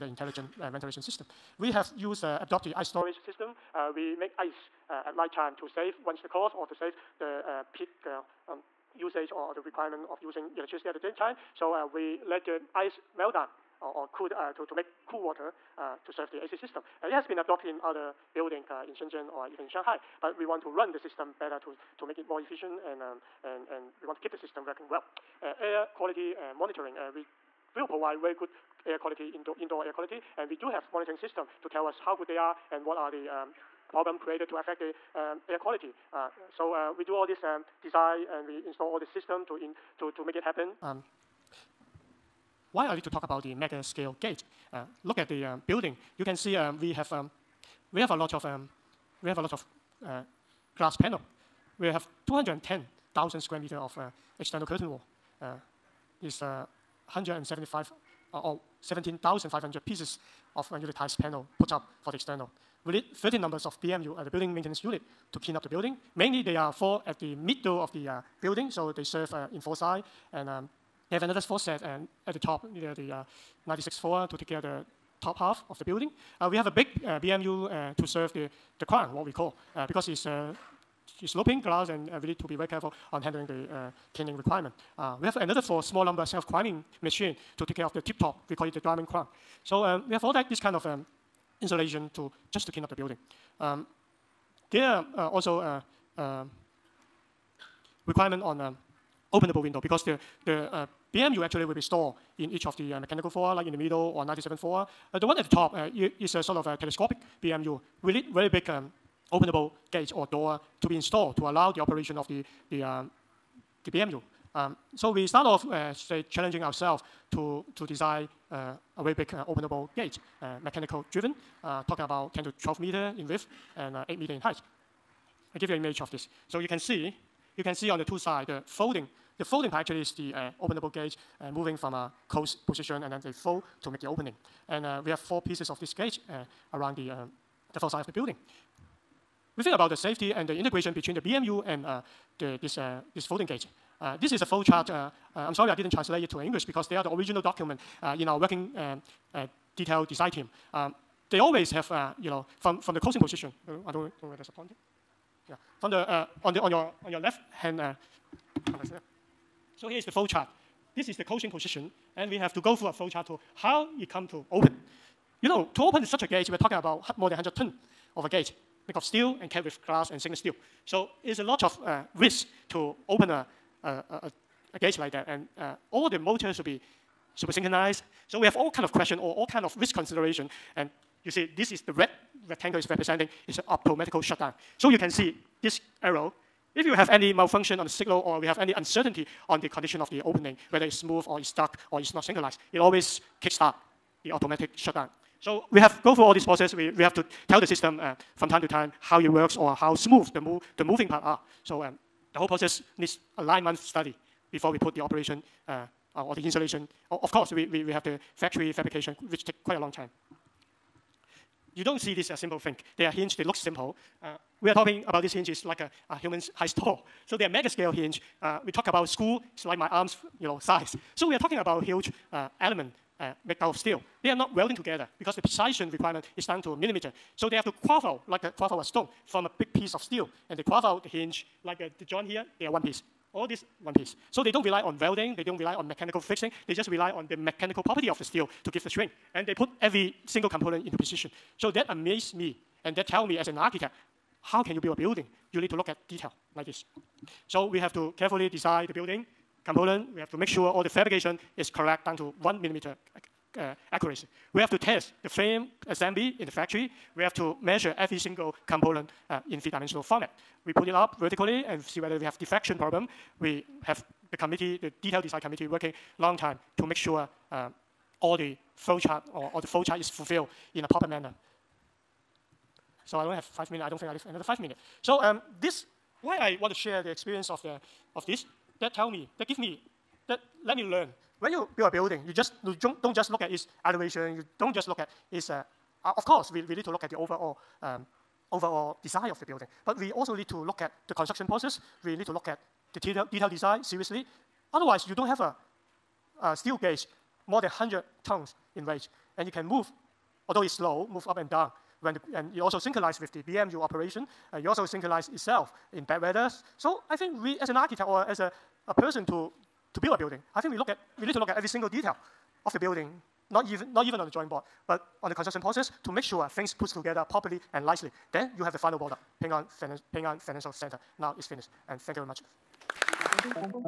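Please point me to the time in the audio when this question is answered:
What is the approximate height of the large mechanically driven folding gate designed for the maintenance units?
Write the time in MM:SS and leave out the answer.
02:04.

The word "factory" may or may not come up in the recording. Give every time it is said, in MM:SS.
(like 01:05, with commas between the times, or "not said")
03:28, 04:16.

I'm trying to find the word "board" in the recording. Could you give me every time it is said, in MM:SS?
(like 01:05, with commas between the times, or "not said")
05:14.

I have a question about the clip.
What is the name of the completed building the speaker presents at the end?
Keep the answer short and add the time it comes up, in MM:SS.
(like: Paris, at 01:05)
Ping An Financial Center, at 05:20.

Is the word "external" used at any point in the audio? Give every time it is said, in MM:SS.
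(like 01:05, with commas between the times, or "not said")
00:54, 01:02.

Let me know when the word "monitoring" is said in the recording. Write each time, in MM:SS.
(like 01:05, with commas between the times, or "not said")
00:26, 00:30.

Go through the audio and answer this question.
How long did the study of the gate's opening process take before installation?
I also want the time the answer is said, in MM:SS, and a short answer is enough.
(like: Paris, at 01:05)
9 months, at 03:23.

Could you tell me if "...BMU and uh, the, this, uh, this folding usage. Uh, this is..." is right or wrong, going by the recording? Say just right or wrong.
wrong.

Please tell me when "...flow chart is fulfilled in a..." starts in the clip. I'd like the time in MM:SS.
04:29.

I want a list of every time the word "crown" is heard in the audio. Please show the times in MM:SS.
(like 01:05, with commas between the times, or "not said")
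01:18, 01:29.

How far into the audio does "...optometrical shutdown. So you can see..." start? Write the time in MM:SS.
03:03.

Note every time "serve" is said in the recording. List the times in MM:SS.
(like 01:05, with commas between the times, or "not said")
00:16, 01:09, 01:18.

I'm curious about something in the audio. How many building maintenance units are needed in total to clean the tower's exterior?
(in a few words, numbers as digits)
13.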